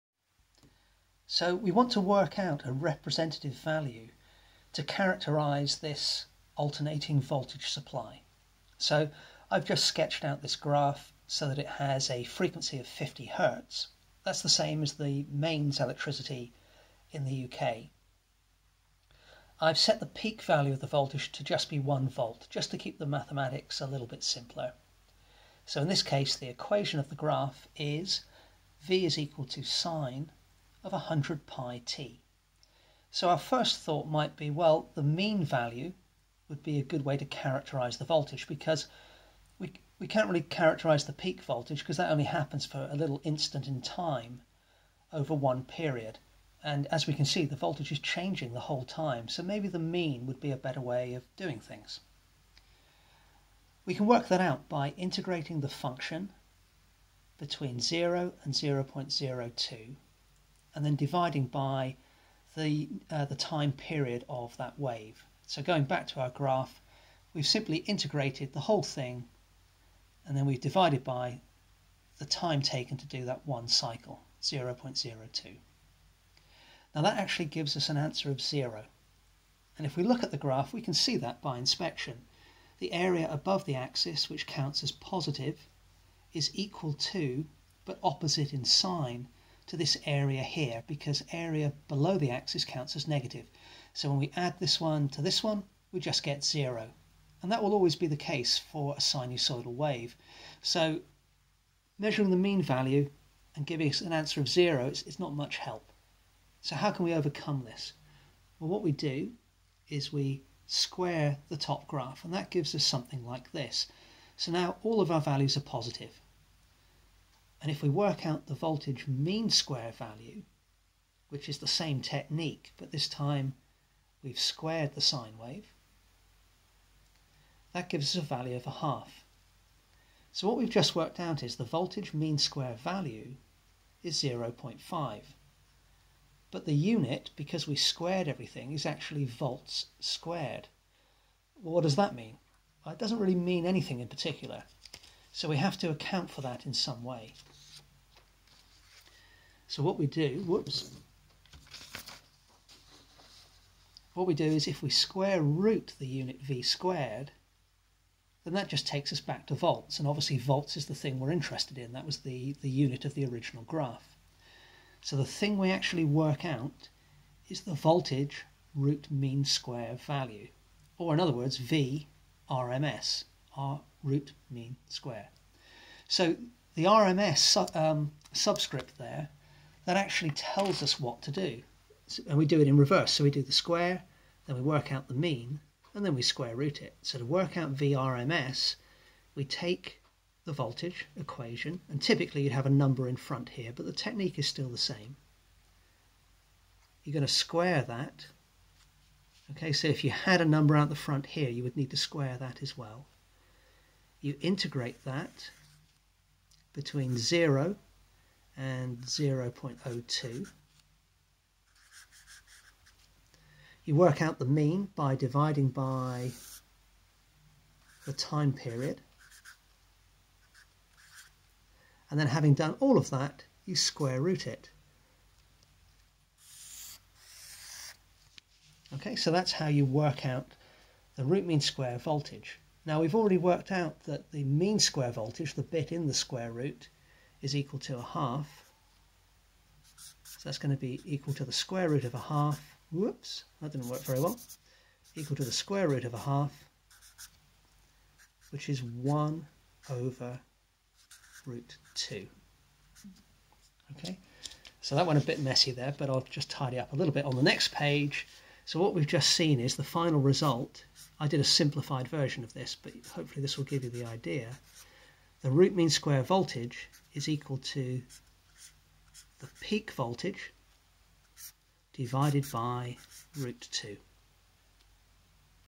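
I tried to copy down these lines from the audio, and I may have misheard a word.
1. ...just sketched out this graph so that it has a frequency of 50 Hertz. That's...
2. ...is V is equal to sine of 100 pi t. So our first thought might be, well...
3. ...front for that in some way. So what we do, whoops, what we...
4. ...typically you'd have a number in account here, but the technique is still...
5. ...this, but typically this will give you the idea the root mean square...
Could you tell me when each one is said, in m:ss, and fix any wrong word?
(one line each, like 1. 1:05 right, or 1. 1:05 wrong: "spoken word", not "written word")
1. 0:09 right
2. 0:27 right
3. 2:25 wrong: "account", not "front"
4. 3:12 wrong: "front", not "account"
5. 4:22 wrong: "hopefully", not "typically".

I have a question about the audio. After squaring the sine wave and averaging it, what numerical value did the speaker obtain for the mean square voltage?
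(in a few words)
0.5.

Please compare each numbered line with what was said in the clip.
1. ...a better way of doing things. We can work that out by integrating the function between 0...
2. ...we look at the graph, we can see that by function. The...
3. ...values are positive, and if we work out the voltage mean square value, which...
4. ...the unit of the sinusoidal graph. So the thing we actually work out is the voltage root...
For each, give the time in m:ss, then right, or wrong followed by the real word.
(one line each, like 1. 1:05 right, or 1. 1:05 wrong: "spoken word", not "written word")
1. 0:50 right
2. 1:19 wrong: "inspection", not "function"
3. 1:55 right
4. 2:42 wrong: "original", not "sinusoidal".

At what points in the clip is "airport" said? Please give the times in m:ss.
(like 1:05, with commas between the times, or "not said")
not said.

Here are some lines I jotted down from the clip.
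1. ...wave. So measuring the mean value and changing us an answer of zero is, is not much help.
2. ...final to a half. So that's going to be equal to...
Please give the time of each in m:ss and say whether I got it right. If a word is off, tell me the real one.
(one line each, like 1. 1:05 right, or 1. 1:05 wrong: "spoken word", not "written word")
1. 1:39 wrong: "giving", not "changing"
2. 3:57 wrong: "equal", not "final".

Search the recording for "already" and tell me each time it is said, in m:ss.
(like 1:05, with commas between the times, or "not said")
3:53.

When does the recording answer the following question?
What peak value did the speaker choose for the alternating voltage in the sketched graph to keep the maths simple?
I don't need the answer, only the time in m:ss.
0:21.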